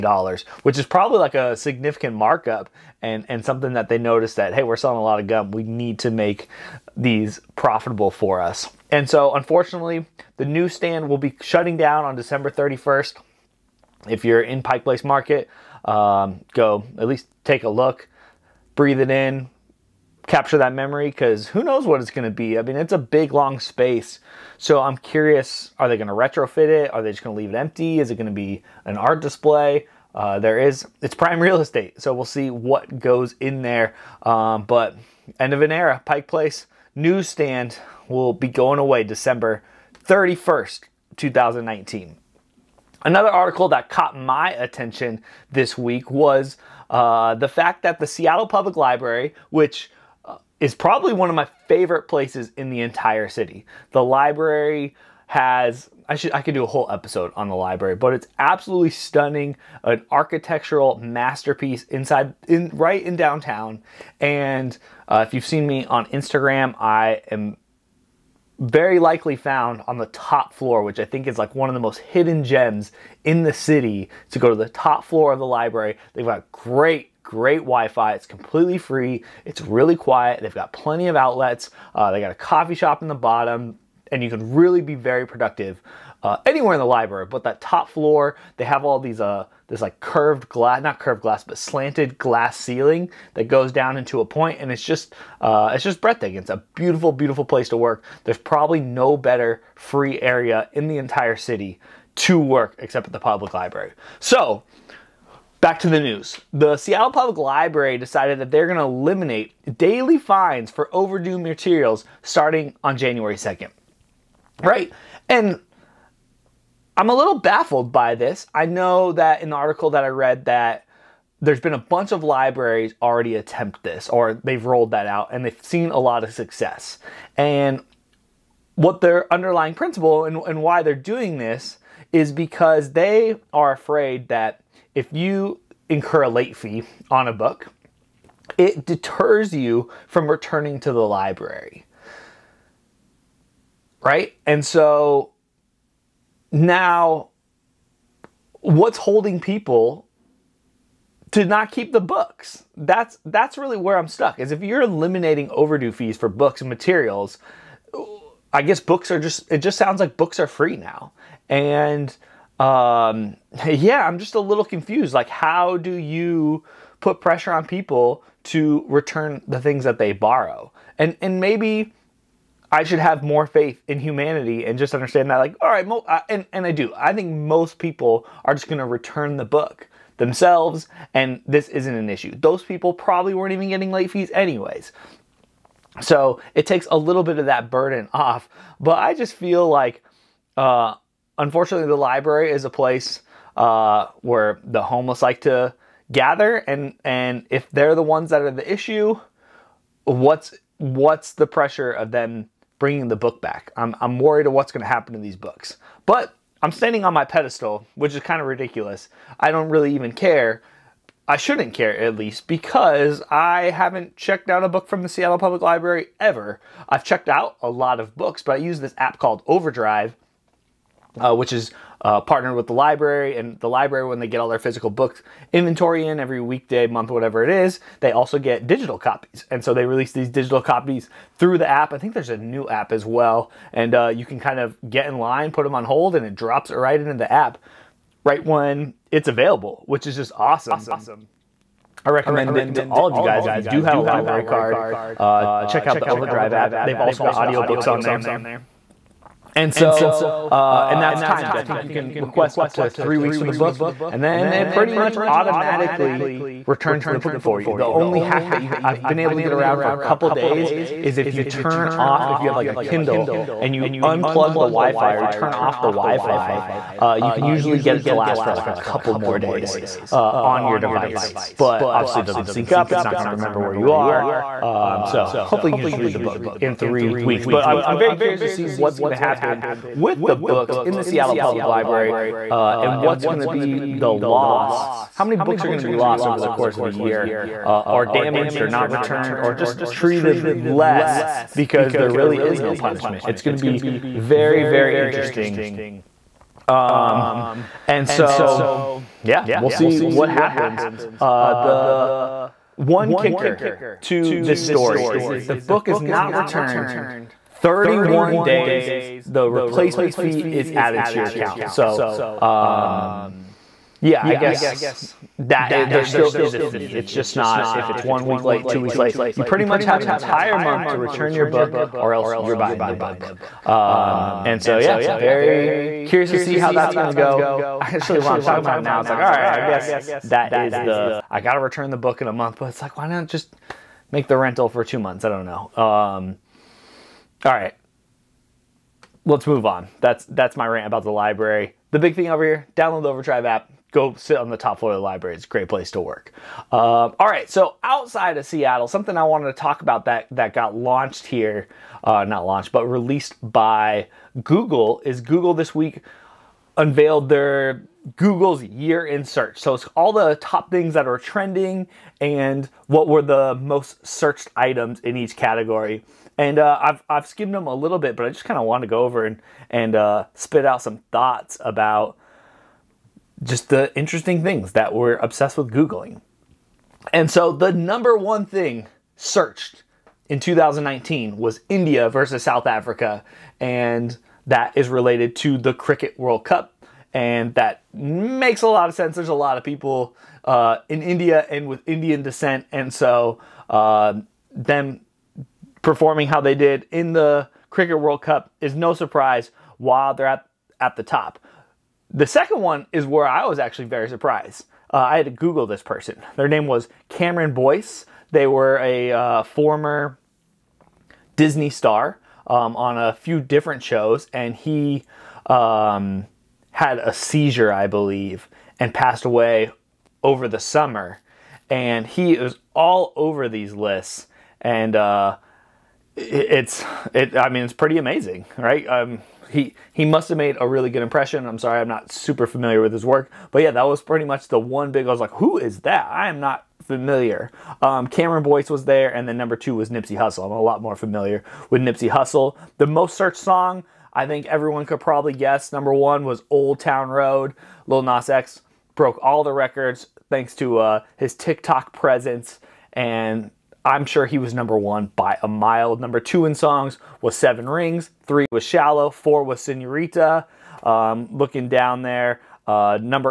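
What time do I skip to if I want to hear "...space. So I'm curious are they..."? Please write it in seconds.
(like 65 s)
23 s.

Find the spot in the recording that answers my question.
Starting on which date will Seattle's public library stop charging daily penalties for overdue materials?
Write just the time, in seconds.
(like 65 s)
112 s.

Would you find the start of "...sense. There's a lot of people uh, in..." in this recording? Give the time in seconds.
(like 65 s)
388 s.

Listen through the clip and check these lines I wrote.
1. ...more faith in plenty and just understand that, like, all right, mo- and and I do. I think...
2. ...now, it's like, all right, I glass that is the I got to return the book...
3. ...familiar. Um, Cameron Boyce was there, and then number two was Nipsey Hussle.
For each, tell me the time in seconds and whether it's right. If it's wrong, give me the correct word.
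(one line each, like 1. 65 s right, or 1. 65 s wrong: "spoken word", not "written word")
1. 173 s wrong: "humanity", not "plenty"
2. 328 s wrong: "guess", not "glass"
3. 436 s right.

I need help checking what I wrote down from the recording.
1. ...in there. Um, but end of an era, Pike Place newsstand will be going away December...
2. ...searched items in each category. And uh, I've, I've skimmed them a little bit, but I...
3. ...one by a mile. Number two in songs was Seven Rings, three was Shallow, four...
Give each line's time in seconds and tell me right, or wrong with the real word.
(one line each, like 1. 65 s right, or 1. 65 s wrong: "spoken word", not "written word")
1. 33 s right
2. 364 s right
3. 454 s right.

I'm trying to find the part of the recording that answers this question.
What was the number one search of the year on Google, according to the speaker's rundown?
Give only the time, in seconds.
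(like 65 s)
381 s.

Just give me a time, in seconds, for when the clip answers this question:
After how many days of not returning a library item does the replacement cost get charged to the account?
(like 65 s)
307 s.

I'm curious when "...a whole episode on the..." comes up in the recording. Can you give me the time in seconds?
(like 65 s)
56 s.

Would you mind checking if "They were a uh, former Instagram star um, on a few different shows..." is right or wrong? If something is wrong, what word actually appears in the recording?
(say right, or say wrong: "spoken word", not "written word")
wrong: "Disney", not "Instagram".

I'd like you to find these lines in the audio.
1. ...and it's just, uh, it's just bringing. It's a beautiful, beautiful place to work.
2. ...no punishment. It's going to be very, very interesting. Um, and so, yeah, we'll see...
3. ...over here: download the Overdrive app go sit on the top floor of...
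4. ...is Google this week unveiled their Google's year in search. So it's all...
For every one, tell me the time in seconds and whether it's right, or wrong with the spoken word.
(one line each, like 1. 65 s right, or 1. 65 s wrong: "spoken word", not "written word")
1. 94 s wrong: "breathtaking", not "bringing"
2. 292 s right
3. 342 s right
4. 355 s right.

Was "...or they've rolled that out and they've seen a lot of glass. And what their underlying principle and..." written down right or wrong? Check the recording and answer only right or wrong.
wrong.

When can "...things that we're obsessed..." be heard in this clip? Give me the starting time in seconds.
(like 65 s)
374 s.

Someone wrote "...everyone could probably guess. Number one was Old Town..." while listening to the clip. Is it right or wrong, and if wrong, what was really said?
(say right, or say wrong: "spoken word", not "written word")
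right.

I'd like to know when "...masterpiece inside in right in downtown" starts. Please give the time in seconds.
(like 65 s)
60 s.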